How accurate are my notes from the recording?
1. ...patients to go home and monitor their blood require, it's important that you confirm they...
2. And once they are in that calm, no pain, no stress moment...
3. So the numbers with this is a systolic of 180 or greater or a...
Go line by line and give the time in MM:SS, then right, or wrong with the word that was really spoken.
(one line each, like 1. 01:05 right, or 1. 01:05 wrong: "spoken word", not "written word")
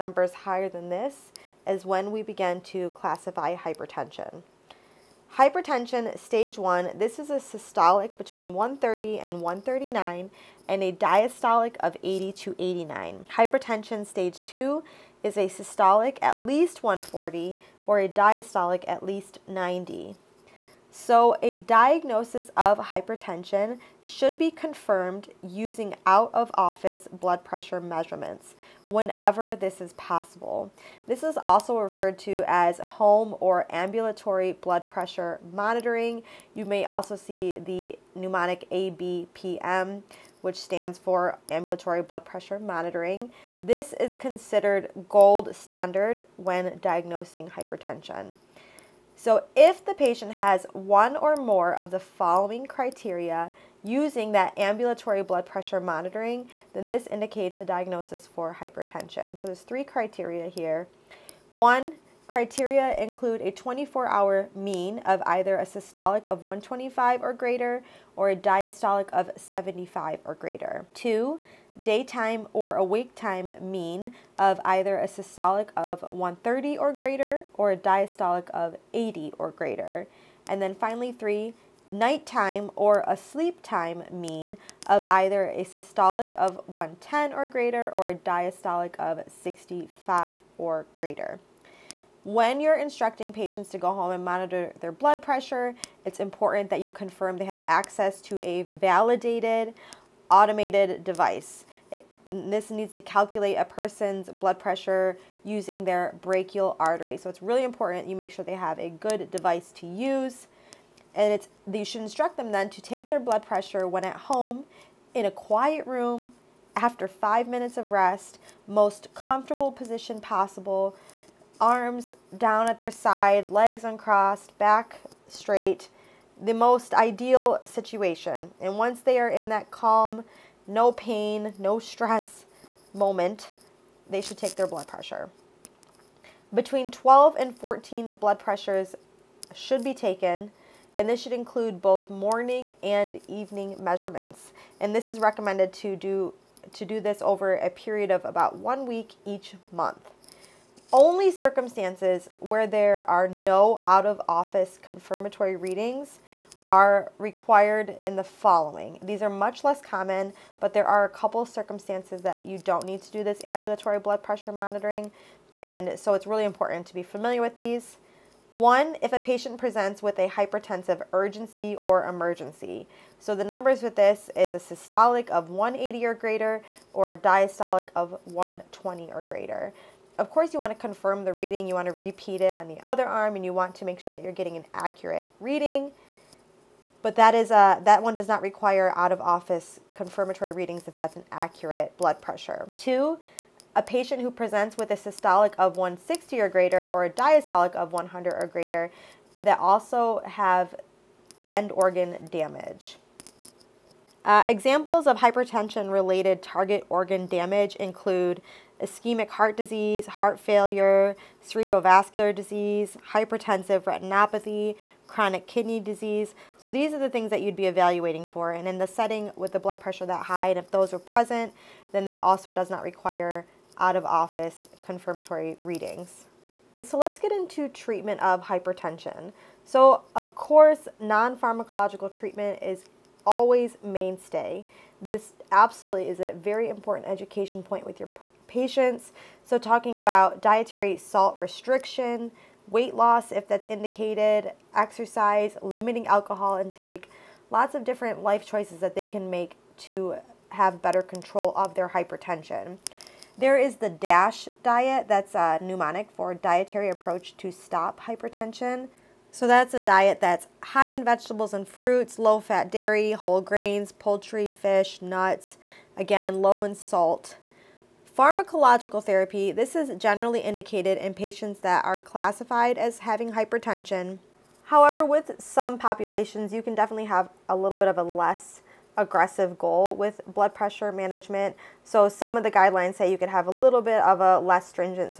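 1. 01:33 wrong: "pressure", not "require"
2. 02:08 right
3. 02:53 right.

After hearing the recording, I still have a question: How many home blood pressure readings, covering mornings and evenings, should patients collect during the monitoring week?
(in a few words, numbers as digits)
Between 12 and 14.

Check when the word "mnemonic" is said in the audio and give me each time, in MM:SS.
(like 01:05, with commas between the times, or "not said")
00:38, 04:15.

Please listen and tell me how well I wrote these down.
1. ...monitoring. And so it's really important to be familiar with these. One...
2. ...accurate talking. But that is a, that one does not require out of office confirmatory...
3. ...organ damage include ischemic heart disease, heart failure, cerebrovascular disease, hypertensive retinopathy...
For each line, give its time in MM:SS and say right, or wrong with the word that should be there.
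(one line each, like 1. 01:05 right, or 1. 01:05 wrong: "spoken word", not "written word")
1. 02:44 right
2. 03:04 wrong: "reading", not "talking"
3. 03:26 right.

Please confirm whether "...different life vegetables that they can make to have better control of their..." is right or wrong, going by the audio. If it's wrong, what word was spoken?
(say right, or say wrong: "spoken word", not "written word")
wrong: "choices", not "vegetables".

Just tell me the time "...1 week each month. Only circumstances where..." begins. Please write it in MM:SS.
02:28.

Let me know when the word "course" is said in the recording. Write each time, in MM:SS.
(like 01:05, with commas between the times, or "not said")
03:00, 03:50.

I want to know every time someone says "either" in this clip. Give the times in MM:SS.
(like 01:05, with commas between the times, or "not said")
01:05, 01:14, 01:25.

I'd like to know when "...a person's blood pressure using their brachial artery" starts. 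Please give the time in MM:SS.
01:43.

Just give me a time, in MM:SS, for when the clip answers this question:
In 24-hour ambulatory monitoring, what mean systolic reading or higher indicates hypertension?
01:06.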